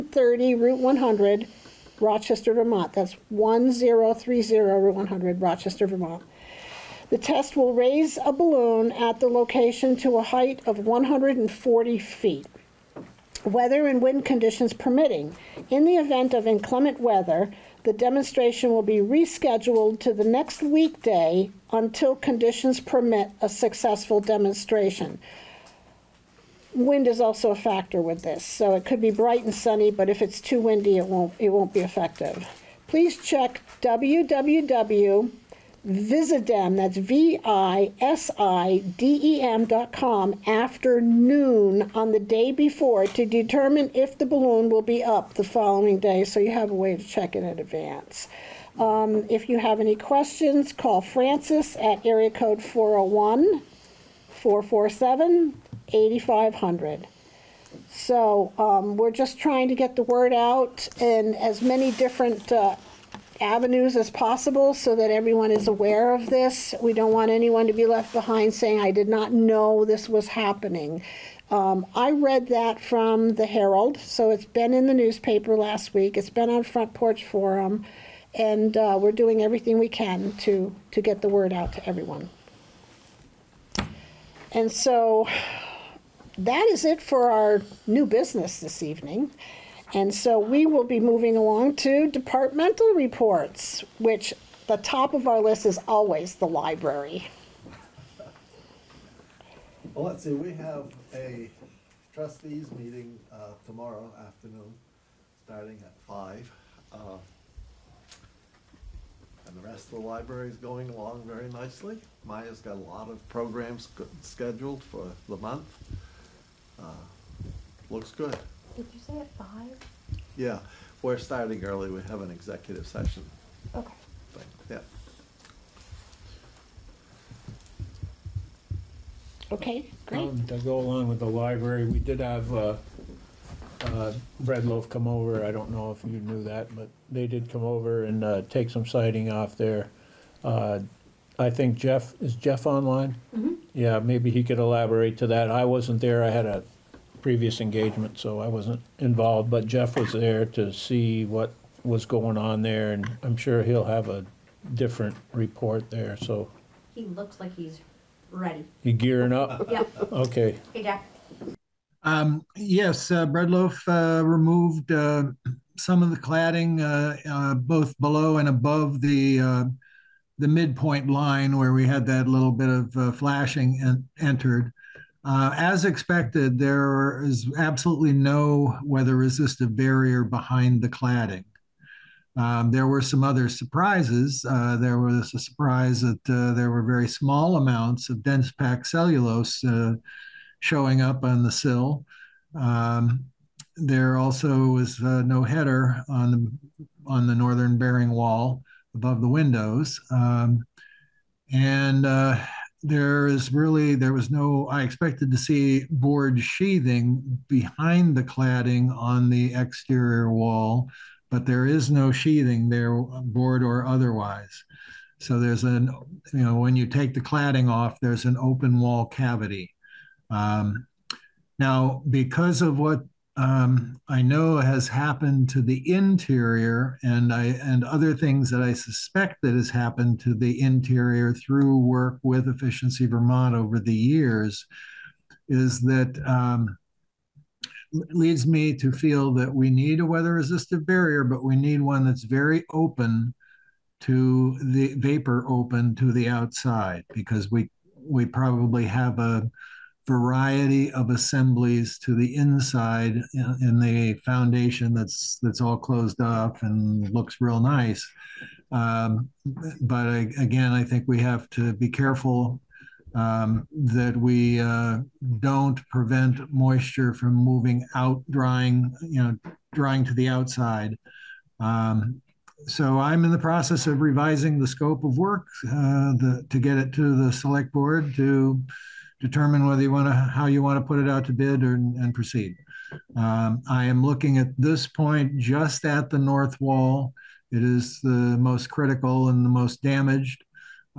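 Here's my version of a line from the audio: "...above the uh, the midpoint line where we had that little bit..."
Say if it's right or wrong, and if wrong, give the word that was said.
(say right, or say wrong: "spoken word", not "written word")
right.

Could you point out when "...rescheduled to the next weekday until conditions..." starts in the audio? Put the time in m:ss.
0:19.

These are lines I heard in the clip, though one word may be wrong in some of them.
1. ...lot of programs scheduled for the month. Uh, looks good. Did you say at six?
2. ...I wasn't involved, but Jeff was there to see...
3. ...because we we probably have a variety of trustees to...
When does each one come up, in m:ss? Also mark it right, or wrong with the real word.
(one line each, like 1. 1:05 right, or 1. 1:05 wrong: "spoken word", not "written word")
1. 1:52 wrong: "five", not "six"
2. 2:28 right
3. 4:07 wrong: "assemblies", not "trustees".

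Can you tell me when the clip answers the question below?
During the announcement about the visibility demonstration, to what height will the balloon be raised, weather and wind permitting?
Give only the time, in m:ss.
0:10.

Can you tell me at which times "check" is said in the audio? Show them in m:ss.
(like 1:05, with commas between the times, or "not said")
0:33, 0:47.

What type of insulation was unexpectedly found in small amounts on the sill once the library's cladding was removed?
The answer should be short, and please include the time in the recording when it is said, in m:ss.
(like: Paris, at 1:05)
dense packed cellulose, at 3:08.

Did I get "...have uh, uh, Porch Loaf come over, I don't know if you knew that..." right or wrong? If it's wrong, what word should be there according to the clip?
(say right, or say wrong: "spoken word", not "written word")
wrong: "Bread", not "Porch".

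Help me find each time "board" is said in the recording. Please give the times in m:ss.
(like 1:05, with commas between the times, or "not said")
3:25, 3:32, 4:37.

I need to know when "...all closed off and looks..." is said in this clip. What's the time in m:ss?
4:15.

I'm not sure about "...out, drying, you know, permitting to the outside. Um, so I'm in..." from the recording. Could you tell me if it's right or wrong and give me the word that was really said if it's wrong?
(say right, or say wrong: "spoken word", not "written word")
wrong: "drying", not "permitting".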